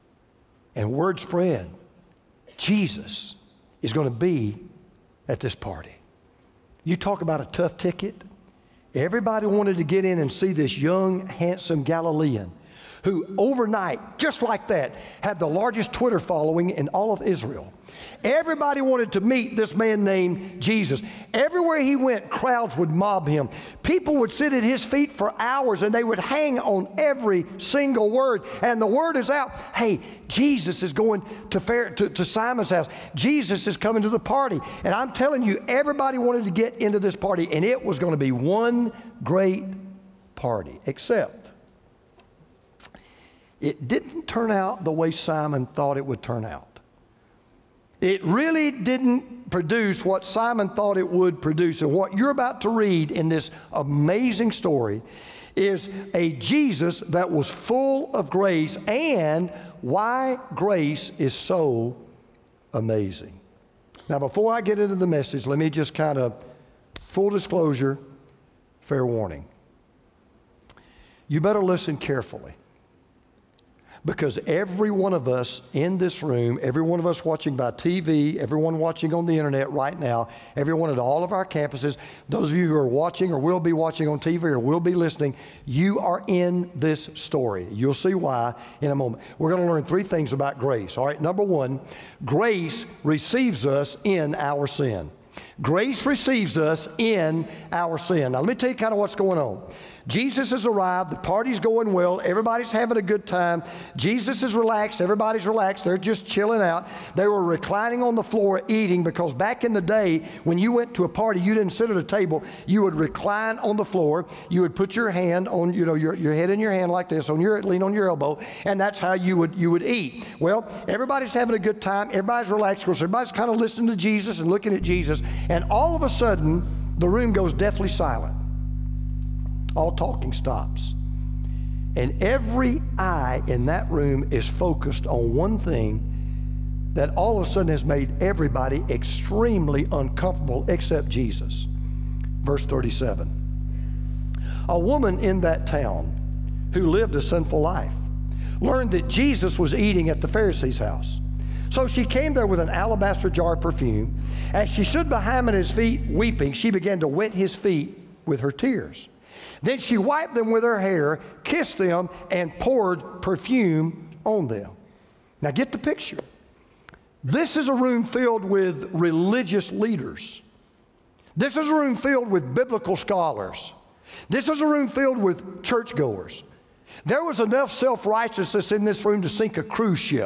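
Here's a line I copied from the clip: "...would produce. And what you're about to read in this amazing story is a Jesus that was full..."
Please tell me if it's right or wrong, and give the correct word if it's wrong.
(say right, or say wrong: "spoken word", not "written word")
right.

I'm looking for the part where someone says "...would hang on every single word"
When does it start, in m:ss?
0:26.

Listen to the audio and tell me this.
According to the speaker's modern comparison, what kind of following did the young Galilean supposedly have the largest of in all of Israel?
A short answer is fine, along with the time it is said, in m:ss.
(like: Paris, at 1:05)
Twitter following, at 0:15.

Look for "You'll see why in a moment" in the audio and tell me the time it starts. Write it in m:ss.
1:27.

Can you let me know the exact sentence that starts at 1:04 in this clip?
Now, before I get into the message, let me just kind of full disclosure, fair warning.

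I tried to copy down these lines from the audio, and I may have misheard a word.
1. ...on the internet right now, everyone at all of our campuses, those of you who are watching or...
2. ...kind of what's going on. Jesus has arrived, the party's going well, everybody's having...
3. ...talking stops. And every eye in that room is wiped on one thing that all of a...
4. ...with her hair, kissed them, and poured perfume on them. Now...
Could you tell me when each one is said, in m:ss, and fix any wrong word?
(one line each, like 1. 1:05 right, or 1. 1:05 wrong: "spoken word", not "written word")
1. 1:19 right
2. 1:38 right
3. 2:09 wrong: "focused", not "wiped"
4. 2:40 right.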